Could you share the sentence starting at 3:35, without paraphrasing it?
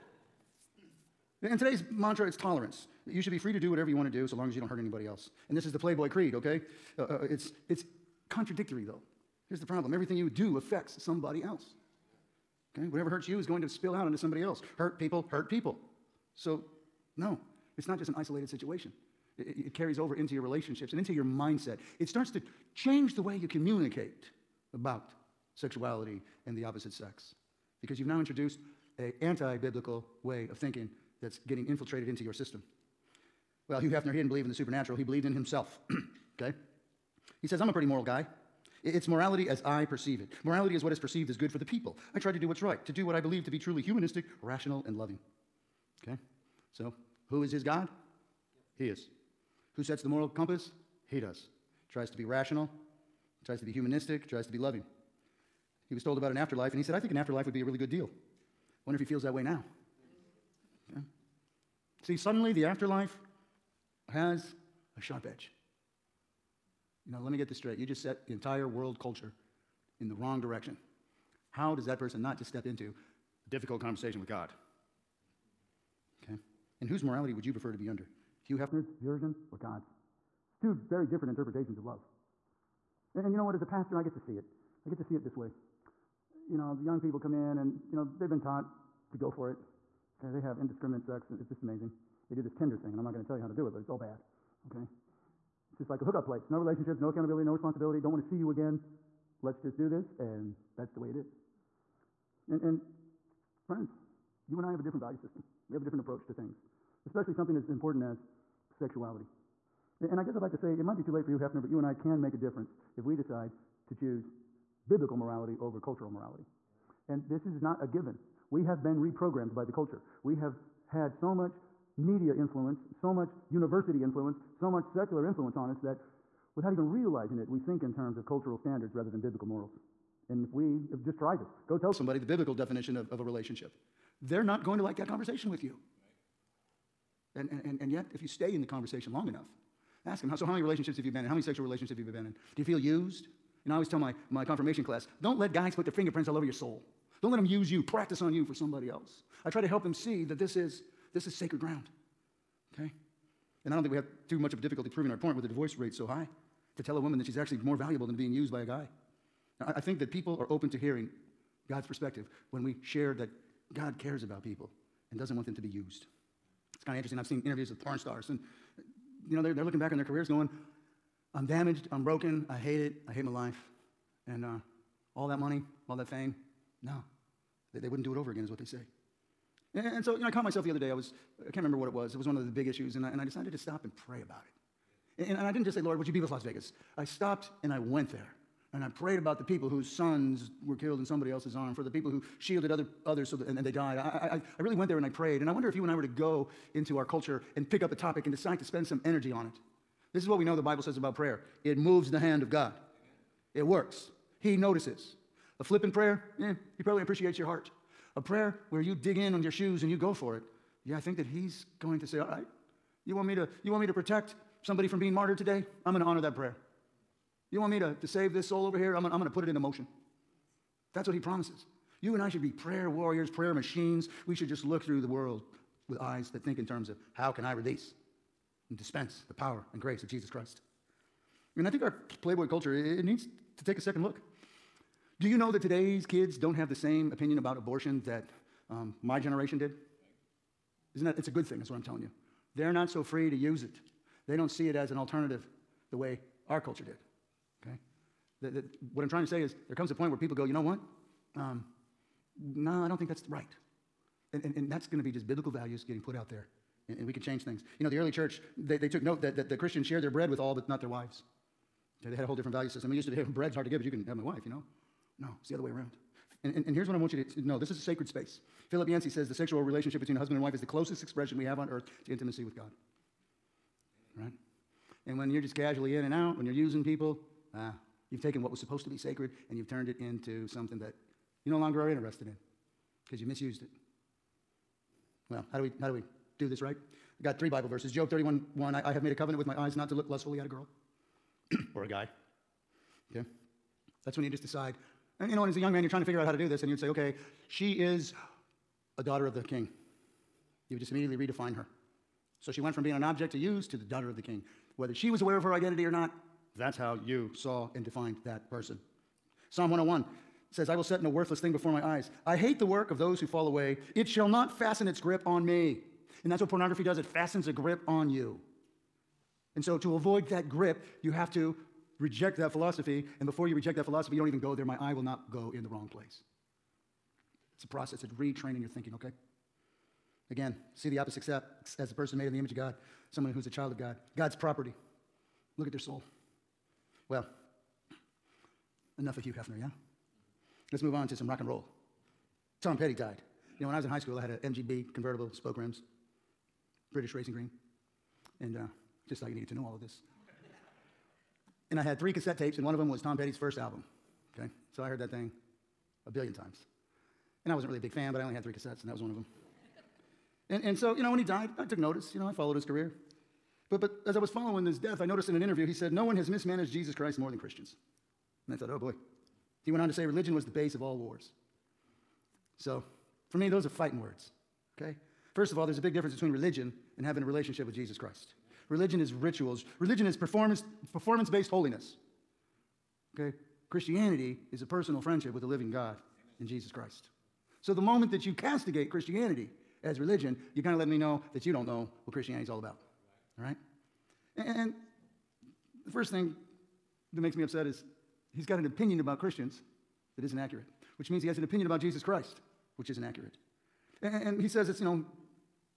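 I'm going to honor that prayer.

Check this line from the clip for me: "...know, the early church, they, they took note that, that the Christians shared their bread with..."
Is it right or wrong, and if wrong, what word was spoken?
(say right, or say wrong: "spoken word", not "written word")
right.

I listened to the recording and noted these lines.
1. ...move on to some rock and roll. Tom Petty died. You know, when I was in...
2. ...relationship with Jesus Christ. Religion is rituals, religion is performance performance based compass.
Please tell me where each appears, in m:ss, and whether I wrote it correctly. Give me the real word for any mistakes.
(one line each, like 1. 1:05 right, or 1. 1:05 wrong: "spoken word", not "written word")
1. 5:40 right
2. 6:17 wrong: "holiness", not "compass".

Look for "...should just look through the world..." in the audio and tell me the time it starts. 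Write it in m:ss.
3:44.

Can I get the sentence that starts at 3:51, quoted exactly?
And I think our Playboy culture, it needs to take a second look.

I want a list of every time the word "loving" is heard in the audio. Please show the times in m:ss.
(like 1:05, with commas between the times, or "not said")
0:44, 0:54.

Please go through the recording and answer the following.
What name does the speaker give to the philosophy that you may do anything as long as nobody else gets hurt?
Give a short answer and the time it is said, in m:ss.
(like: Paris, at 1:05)
The Playboy Creed, at 0:05.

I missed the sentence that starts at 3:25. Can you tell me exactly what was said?
A flippant prayer, eh, he probably appreciates your heart.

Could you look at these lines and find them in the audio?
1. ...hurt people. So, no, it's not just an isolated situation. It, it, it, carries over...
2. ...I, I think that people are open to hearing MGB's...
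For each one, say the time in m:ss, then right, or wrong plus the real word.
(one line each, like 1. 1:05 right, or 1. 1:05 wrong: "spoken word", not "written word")
1. 0:15 right
2. 2:39 wrong: "God", not "MGB".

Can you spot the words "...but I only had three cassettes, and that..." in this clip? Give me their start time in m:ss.
5:58.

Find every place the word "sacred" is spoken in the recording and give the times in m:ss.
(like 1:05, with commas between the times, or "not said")
2:31, 4:27, 4:38.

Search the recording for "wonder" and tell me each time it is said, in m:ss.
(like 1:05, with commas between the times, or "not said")
0:58, 3:15.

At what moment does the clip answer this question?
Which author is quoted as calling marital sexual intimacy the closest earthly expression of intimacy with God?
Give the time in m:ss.
4:28.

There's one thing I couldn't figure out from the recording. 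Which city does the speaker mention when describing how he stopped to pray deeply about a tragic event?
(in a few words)
Las Vegas.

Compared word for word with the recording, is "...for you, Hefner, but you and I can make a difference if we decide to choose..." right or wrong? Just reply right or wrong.
right.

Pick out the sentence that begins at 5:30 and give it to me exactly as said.
Again, see the opposite sex as a person made in the image of God, someone who's a child of God, God's property.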